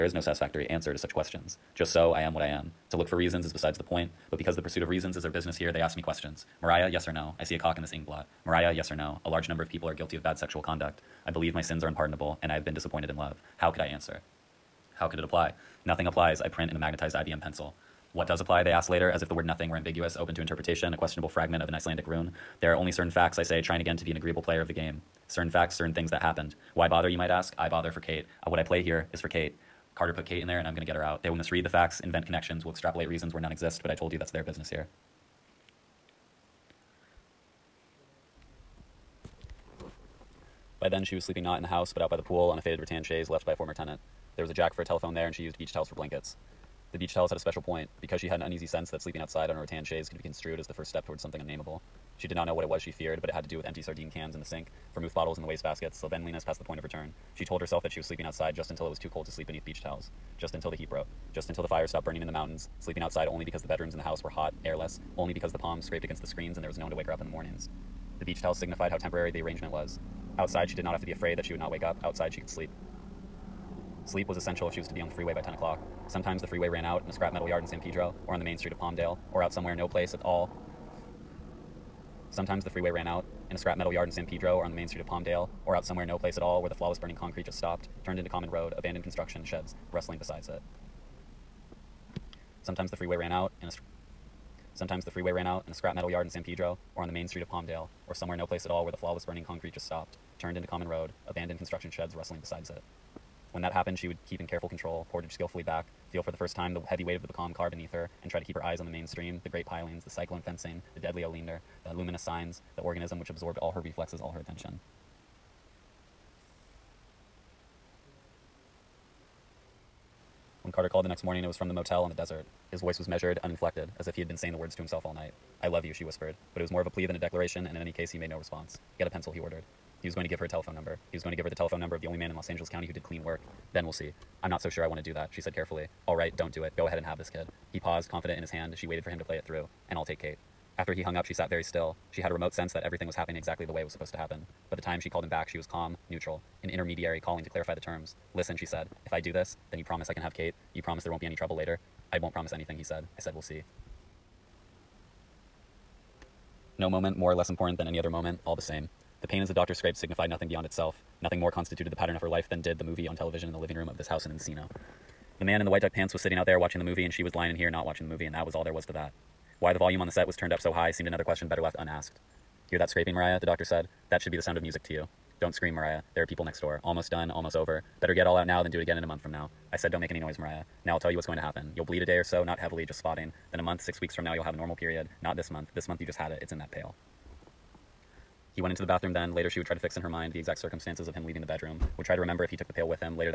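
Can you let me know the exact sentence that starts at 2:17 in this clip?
He paused, confident in his hand.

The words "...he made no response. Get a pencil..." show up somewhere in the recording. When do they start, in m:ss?
2:08.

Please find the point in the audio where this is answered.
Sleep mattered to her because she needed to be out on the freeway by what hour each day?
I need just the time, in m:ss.
1:15.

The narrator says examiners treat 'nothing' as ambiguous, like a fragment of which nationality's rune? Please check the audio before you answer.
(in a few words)
Icelandic.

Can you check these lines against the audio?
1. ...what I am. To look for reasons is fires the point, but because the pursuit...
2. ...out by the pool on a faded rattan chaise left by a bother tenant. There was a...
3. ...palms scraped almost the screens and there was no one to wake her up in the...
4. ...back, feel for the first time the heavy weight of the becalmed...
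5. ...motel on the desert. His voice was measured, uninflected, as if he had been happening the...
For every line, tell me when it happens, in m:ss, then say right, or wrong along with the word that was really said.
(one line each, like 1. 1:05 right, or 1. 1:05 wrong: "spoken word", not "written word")
1. 0:02 wrong: "besides", not "fires"
2. 0:42 wrong: "former", not "bother"
3. 1:05 wrong: "against", not "almost"
4. 1:45 right
5. 2:01 wrong: "saying", not "happening".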